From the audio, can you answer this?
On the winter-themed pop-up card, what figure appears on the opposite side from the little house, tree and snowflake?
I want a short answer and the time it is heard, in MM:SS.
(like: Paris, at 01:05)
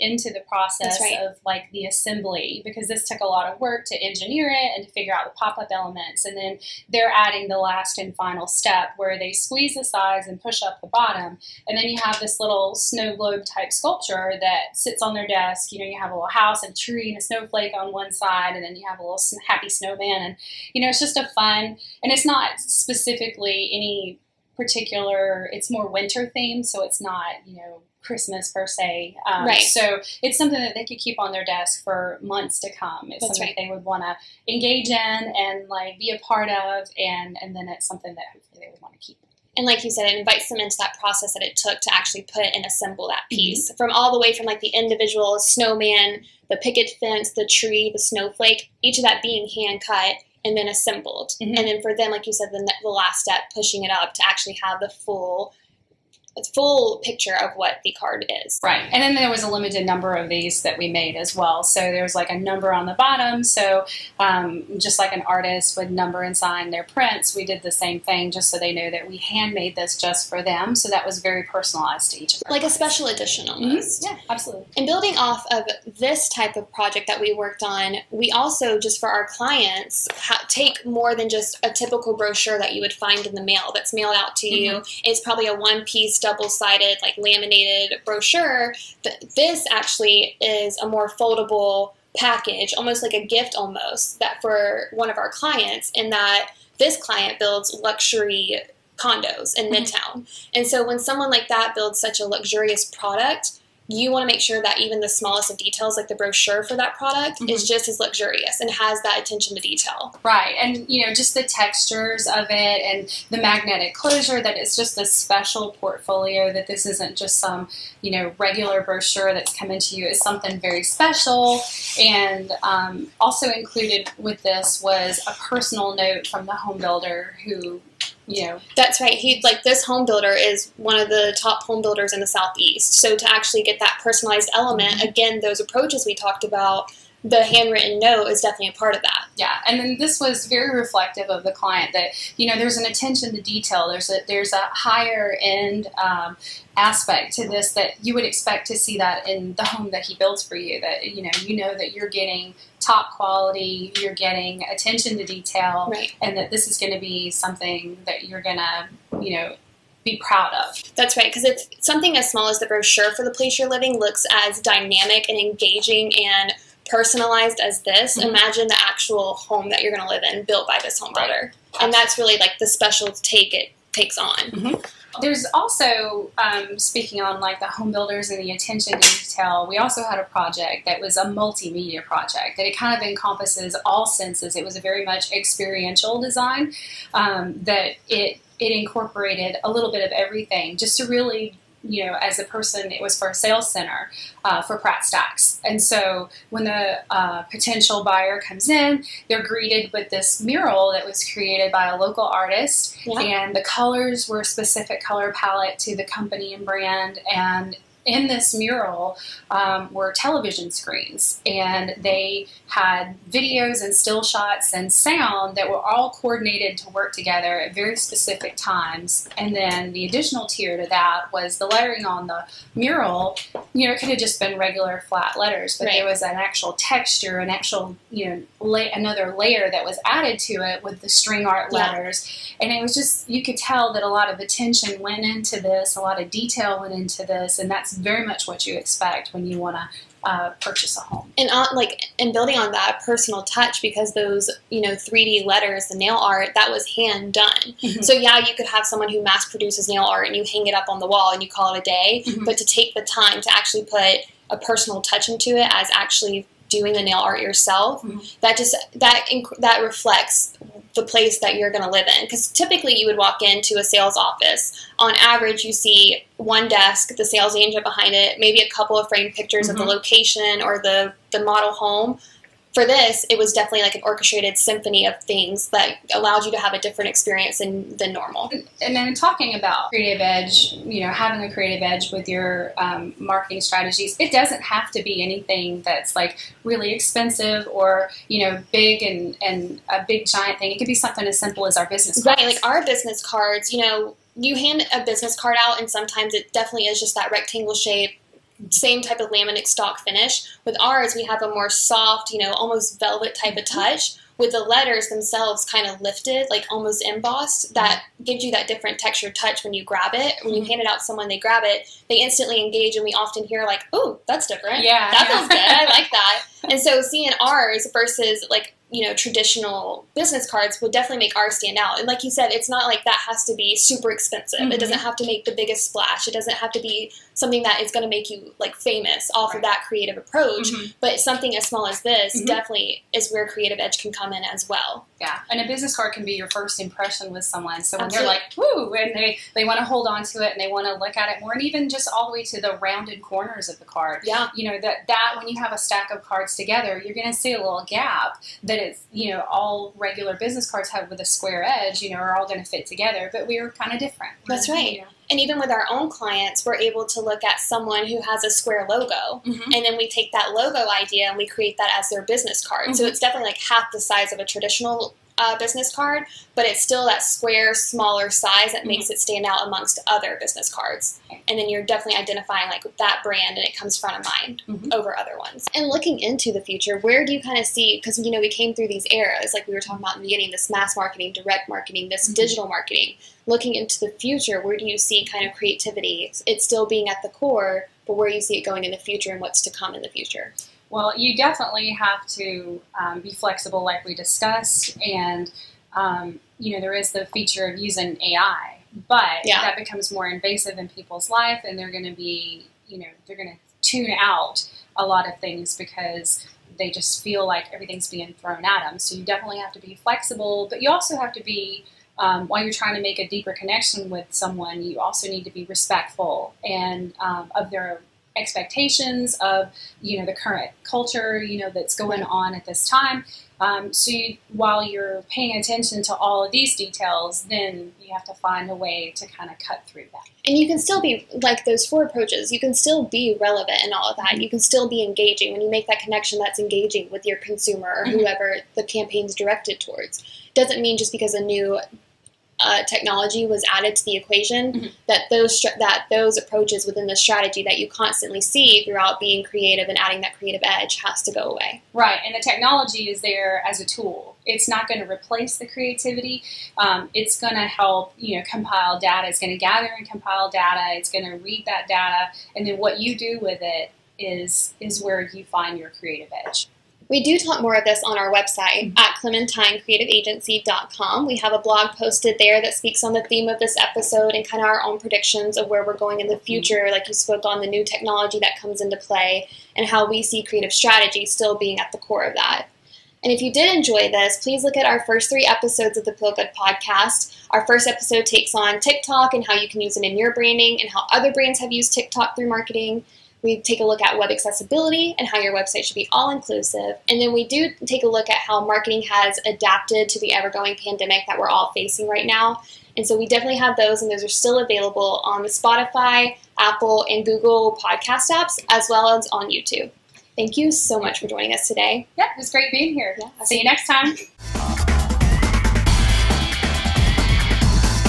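happy snowman, at 00:19.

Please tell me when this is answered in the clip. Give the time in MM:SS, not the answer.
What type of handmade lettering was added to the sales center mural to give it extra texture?
03:51.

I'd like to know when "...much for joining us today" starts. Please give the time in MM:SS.
08:30.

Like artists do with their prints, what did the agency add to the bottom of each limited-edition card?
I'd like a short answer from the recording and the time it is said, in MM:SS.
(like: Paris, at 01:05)
a number, at 01:02.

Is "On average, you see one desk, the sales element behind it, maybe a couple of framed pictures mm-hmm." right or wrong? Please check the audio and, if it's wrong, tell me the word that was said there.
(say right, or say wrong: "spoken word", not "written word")
wrong: "agent", not "element".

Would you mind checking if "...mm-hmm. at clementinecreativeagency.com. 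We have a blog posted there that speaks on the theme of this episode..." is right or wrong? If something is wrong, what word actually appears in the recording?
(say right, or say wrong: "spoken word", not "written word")
right.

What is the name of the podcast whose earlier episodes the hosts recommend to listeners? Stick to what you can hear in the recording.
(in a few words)
Peel Good.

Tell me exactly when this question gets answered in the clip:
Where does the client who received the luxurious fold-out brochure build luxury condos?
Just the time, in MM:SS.
01:39.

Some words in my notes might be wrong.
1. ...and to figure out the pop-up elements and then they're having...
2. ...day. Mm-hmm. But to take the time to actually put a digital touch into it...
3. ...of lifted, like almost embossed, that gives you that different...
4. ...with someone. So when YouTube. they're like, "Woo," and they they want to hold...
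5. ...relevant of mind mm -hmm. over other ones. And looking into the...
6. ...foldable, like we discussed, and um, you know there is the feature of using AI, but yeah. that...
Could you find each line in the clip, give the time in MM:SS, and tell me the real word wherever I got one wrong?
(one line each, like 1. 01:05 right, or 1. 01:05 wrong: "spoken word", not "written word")
1. 00:04 wrong: "adding", not "having"
2. 04:11 wrong: "personal", not "digital"
3. 05:05 right
4. 05:37 wrong: "Absolutely", not "YouTube"
5. 06:14 wrong: "front", not "relevant"
6. 06:33 wrong: "flexible", not "foldable".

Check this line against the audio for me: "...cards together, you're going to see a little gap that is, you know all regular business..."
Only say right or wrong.
right.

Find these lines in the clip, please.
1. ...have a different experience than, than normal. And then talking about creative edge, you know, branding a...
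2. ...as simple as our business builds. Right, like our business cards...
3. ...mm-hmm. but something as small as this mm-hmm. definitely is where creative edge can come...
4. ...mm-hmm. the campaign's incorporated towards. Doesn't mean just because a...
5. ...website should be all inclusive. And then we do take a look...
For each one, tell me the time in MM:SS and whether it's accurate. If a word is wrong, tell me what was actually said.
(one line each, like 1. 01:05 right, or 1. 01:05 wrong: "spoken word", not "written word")
1. 04:36 wrong: "having", not "branding"
2. 04:51 wrong: "cards", not "builds"
3. 05:30 right
4. 07:18 wrong: "directed", not "incorporated"
5. 08:15 right.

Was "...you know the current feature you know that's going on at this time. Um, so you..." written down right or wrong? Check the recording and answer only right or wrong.
wrong.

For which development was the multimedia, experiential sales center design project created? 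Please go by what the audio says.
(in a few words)
Pratt Stacks.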